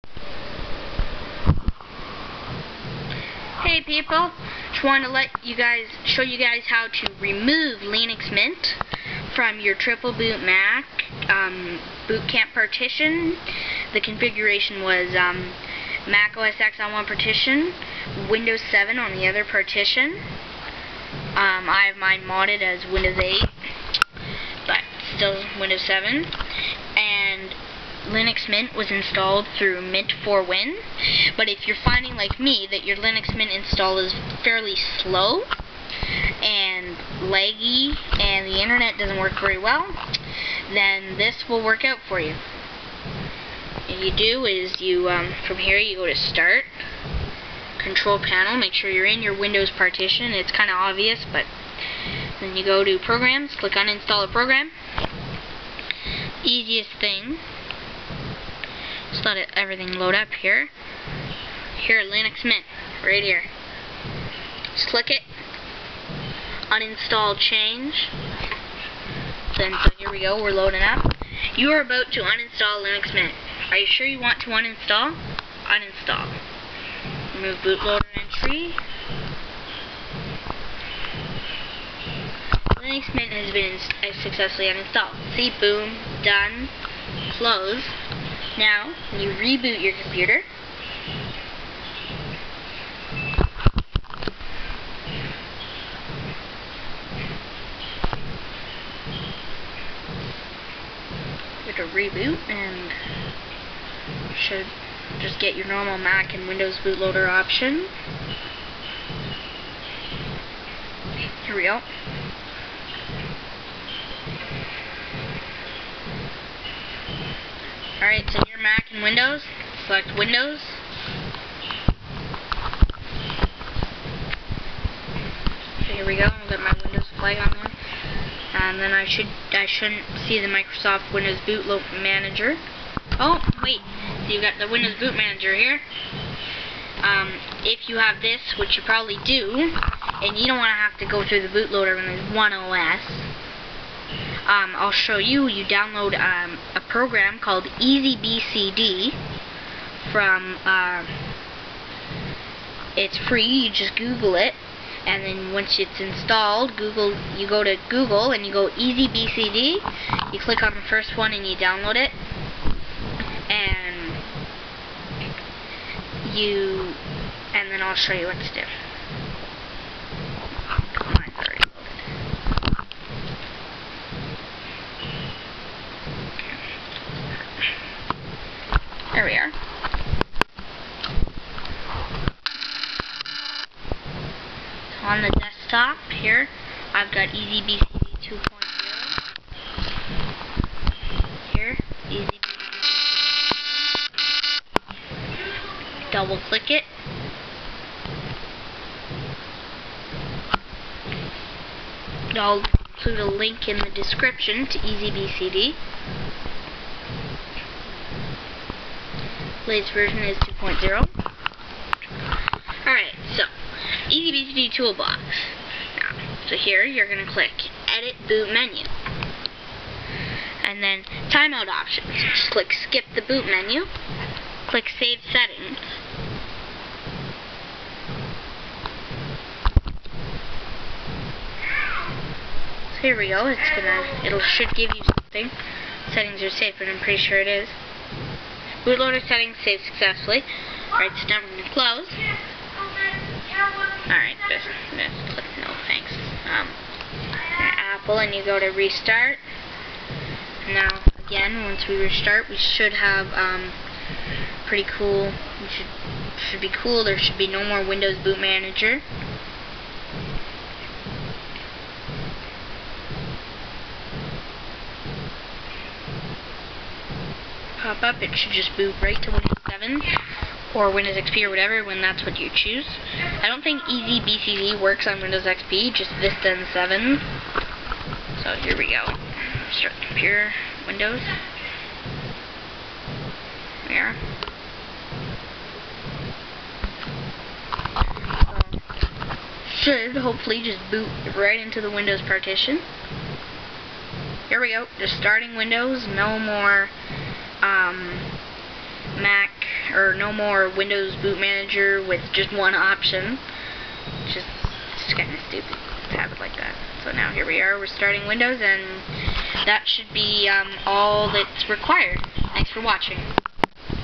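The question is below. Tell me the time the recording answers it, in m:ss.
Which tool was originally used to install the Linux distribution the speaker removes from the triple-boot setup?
0:29.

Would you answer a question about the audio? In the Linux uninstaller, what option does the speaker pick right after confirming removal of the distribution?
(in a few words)
Remove bootloader entry.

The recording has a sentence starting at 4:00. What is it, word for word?
Alright, so now we're going to close.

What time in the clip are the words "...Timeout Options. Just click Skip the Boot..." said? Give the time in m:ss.
3:41.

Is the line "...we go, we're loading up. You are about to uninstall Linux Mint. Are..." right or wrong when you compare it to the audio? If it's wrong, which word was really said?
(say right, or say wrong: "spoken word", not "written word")
right.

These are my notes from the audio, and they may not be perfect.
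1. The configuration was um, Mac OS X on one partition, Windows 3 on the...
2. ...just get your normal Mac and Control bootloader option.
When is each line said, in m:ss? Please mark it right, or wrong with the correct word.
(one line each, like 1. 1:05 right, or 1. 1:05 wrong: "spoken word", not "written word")
1. 0:13 wrong: "7", not "3"
2. 1:45 wrong: "Windows", not "Control".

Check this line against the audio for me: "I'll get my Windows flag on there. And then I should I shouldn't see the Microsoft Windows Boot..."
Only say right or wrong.
right.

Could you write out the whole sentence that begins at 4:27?
pop up, it should just move right to Windows 7 or Windows XP or whatever when that's what you choose.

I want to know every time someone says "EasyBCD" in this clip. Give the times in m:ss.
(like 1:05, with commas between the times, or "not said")
2:27, 2:38, 3:07, 3:12, 3:24, 3:34, 4:33.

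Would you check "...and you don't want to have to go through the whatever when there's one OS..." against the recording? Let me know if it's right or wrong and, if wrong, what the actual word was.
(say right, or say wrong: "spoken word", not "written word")
wrong: "bootloader", not "whatever".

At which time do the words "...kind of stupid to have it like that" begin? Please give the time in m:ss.
5:05.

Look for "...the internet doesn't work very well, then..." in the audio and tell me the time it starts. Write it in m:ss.
0:38.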